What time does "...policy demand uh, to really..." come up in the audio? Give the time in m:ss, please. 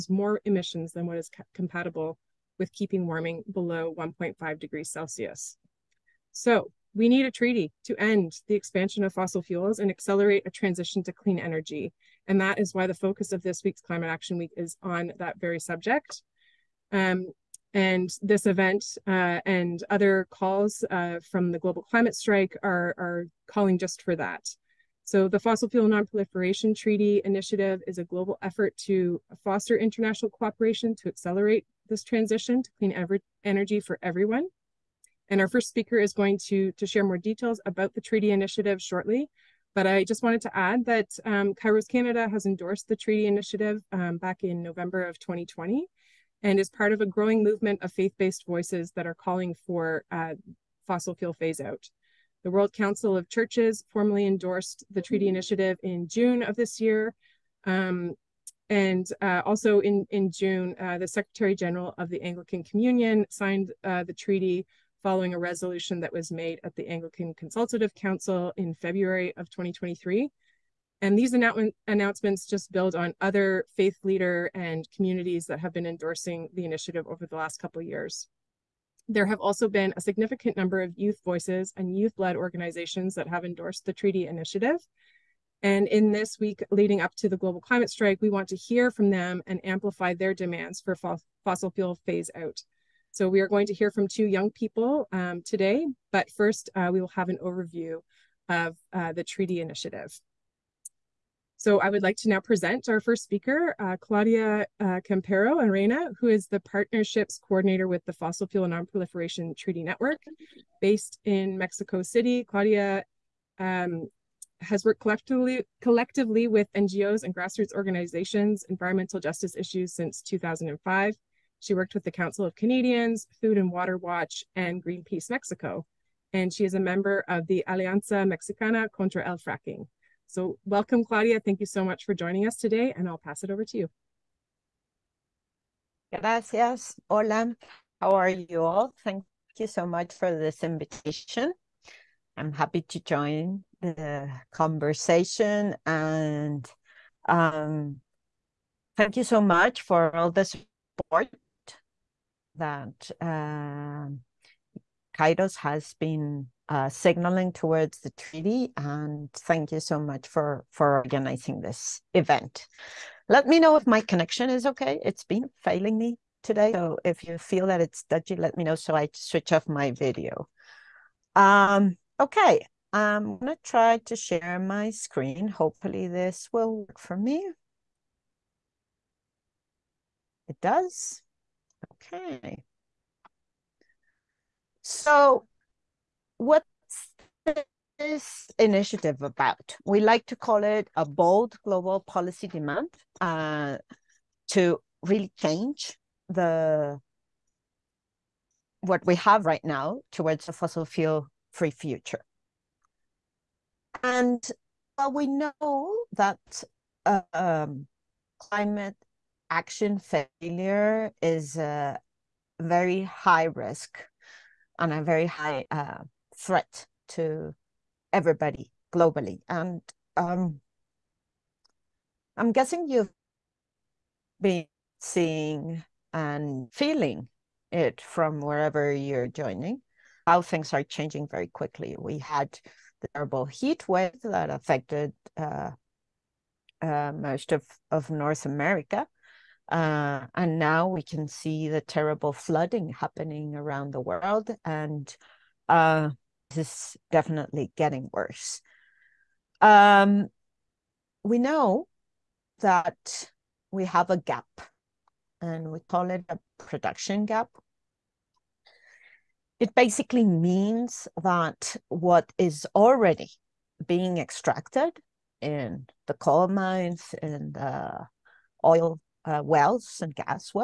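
3:11.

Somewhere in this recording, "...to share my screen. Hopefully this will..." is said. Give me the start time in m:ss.
2:53.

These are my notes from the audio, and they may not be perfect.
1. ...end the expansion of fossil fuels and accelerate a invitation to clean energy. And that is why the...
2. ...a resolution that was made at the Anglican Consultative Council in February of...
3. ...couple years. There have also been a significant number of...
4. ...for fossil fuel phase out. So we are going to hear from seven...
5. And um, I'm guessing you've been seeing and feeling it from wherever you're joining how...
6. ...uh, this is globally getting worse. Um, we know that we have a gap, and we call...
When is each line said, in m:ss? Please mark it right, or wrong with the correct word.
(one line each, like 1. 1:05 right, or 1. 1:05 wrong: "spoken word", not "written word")
1. 0:07 wrong: "transition", not "invitation"
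2. 1:05 right
3. 1:17 right
4. 1:30 wrong: "two", not "seven"
5. 3:39 right
6. 4:05 wrong: "definitely", not "globally".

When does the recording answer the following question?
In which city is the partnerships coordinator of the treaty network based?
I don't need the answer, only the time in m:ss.
1:51.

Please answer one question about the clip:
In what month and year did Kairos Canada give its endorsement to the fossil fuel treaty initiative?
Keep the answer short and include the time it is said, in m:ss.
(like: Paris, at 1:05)
November 2020, at 0:44.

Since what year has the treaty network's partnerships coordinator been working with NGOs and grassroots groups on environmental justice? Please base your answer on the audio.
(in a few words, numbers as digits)
2005.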